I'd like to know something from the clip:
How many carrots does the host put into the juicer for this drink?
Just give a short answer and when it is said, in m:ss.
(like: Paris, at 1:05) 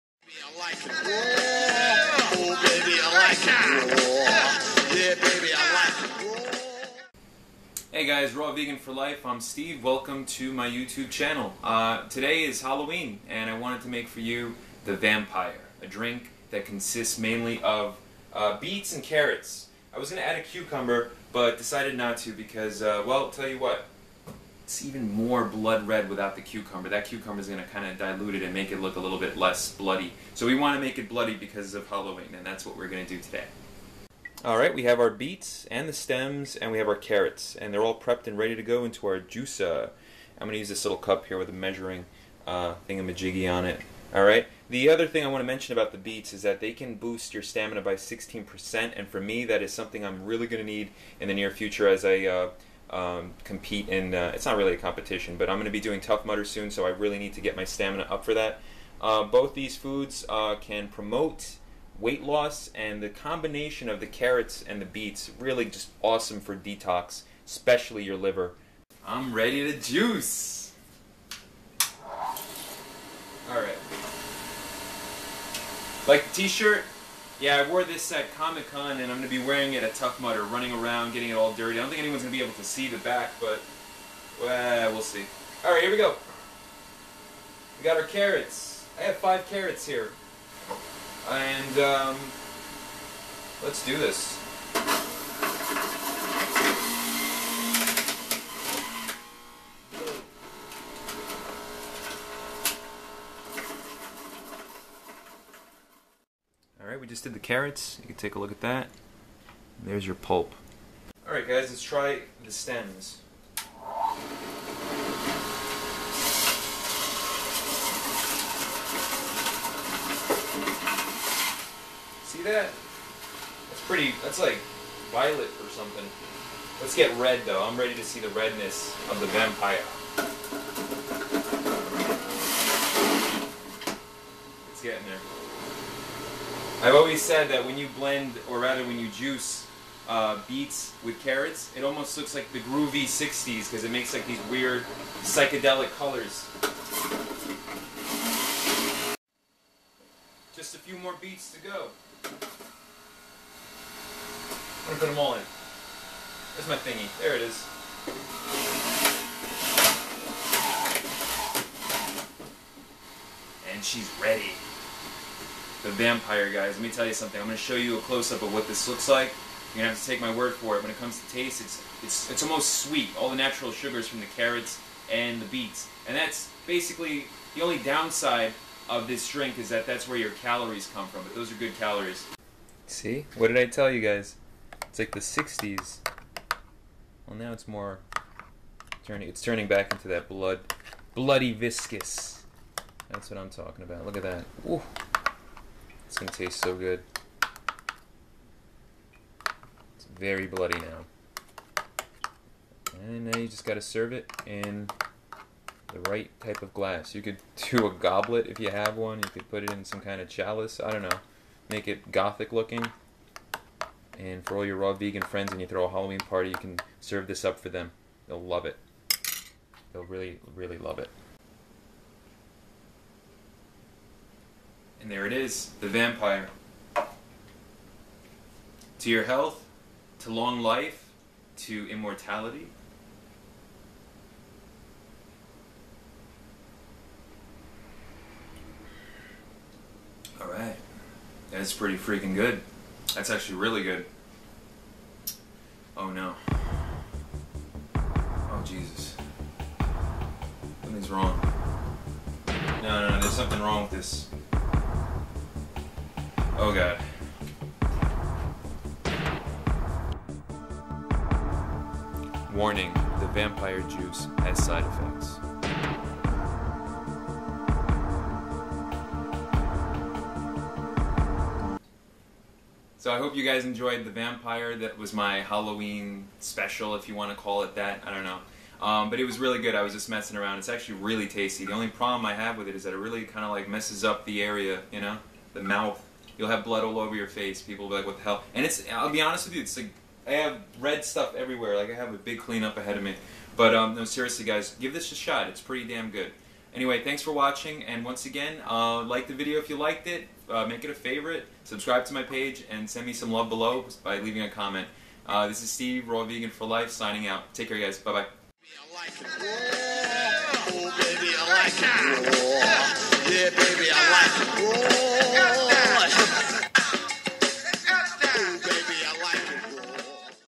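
5, at 1:29.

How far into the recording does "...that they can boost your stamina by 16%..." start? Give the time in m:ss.
0:46.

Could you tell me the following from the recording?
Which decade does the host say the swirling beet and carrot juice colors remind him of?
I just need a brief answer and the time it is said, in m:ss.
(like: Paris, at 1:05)
The 60s, at 2:22.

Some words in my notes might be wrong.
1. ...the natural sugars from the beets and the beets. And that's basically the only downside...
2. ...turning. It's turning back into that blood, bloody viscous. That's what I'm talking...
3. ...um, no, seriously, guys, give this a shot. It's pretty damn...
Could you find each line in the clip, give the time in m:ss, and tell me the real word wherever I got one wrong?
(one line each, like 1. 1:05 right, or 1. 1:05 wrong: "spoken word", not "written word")
1. 2:53 wrong: "carrots", not "beets"
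2. 3:09 right
3. 4:53 right.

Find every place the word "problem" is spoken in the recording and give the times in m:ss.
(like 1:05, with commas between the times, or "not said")
4:41.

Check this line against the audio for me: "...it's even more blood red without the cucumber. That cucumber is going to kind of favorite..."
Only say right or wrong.
wrong.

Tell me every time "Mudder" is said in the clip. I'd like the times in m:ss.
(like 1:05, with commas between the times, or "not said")
0:56, 1:20.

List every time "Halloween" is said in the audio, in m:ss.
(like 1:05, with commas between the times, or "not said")
0:12, 0:31, 3:35, 4:35.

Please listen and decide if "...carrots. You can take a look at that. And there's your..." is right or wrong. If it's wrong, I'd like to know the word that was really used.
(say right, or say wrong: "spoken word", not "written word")
right.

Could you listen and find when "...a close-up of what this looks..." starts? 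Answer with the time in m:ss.
2:47.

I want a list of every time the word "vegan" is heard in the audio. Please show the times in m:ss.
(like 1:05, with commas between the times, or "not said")
0:08, 3:34, 5:06.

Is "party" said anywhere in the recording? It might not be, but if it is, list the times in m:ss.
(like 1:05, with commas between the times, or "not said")
3:36.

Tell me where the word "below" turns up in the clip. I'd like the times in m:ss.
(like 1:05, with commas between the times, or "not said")
5:03.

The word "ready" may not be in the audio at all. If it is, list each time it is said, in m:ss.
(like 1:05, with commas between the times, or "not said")
0:38, 1:09, 2:07, 2:44.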